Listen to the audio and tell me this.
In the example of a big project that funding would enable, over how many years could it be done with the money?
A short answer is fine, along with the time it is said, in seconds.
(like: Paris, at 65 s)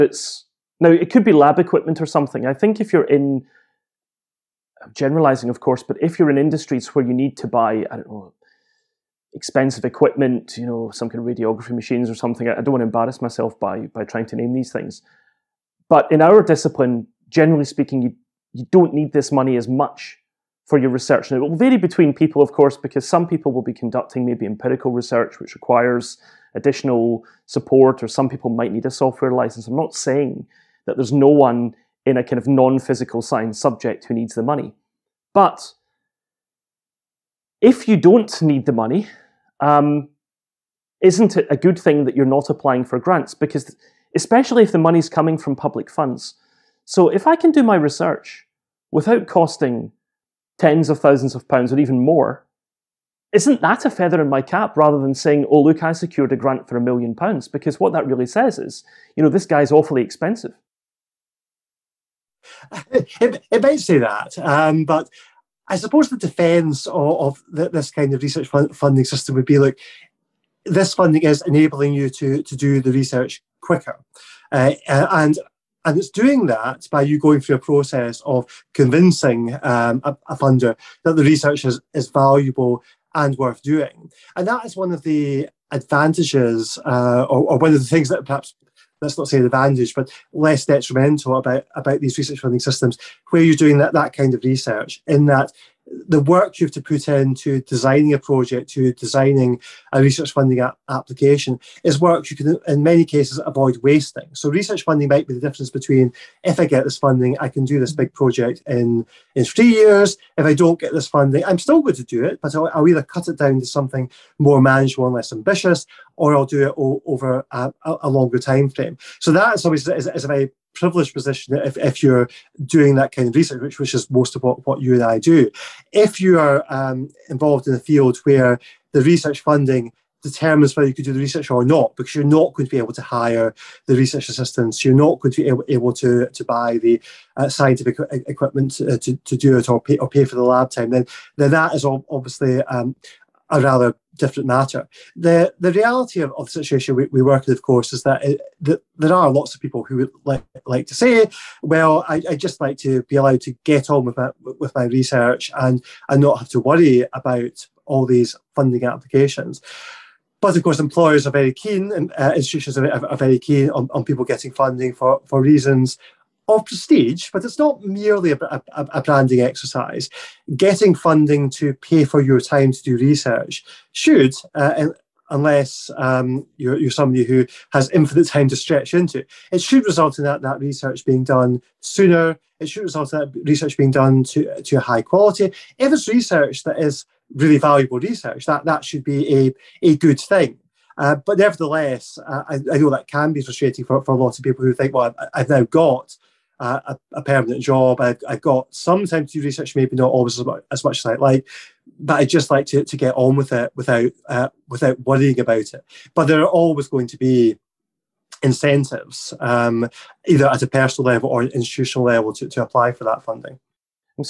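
3 years, at 109 s.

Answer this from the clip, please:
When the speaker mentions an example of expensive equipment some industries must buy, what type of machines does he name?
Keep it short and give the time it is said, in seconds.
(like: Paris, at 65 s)
radiography machines, at 11 s.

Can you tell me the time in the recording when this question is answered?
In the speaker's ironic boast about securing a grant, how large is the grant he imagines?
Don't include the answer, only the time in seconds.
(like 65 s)
56 s.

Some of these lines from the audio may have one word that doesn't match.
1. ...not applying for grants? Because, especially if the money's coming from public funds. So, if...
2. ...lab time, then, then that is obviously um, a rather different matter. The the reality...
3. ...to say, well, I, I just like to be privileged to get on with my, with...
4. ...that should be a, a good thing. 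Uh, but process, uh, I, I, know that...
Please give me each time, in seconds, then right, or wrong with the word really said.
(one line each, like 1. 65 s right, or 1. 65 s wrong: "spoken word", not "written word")
1. 42 s right
2. 140 s right
3. 150 s wrong: "allowed", not "privileged"
4. 188 s wrong: "nevertheless", not "process".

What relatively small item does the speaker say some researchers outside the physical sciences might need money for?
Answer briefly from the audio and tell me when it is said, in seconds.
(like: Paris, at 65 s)
software license, at 28 s.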